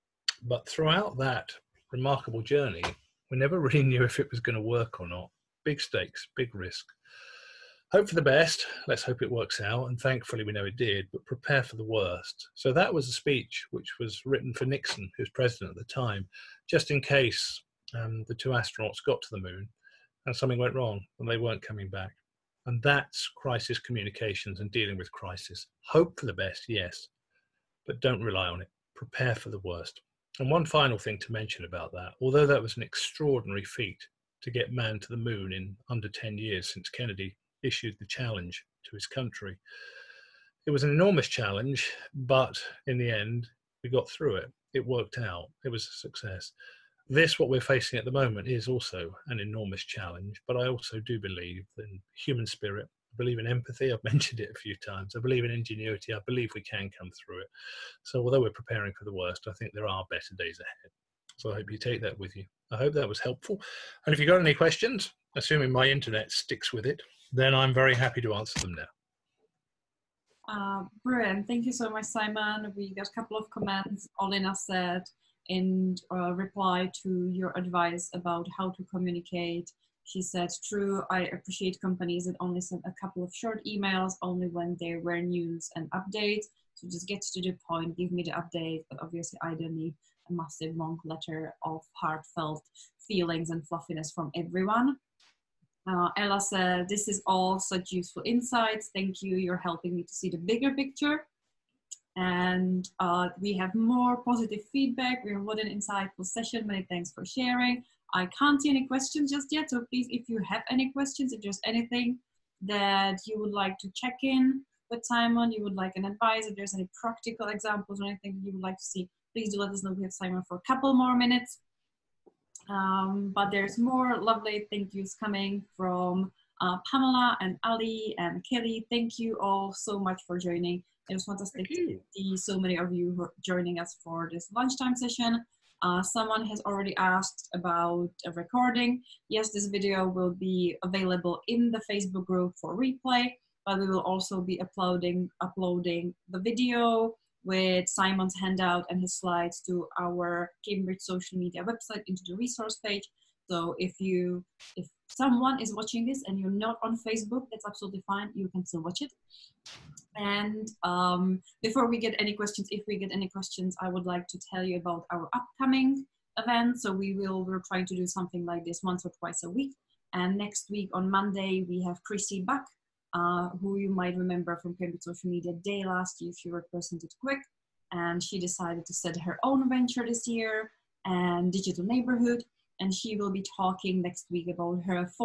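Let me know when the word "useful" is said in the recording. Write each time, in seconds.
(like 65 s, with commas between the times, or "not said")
97 s.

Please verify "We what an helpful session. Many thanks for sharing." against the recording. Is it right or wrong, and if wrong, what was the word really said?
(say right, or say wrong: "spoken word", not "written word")
wrong: "insightful", not "helpful".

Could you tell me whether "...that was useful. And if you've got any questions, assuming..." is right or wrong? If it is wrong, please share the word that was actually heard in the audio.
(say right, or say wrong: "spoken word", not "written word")
wrong: "helpful", not "useful".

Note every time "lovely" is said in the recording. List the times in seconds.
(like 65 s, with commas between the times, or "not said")
124 s.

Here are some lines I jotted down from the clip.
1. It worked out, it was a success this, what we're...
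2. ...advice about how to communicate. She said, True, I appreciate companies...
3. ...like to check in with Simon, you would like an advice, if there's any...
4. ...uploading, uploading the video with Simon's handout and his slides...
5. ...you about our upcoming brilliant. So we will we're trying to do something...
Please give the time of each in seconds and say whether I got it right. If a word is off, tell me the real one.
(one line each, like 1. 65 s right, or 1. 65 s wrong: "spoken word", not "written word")
1. 44 s right
2. 77 s right
3. 113 s right
4. 144 s right
5. 164 s wrong: "event", not "brilliant".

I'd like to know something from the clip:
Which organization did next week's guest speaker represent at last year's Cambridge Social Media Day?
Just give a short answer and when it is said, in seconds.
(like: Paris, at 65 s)
Quick, at 177 s.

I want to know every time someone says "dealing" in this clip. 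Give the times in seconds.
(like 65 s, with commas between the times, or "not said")
24 s.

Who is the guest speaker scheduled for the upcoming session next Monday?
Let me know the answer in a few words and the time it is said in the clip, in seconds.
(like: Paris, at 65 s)
Chrissy Buck, at 172 s.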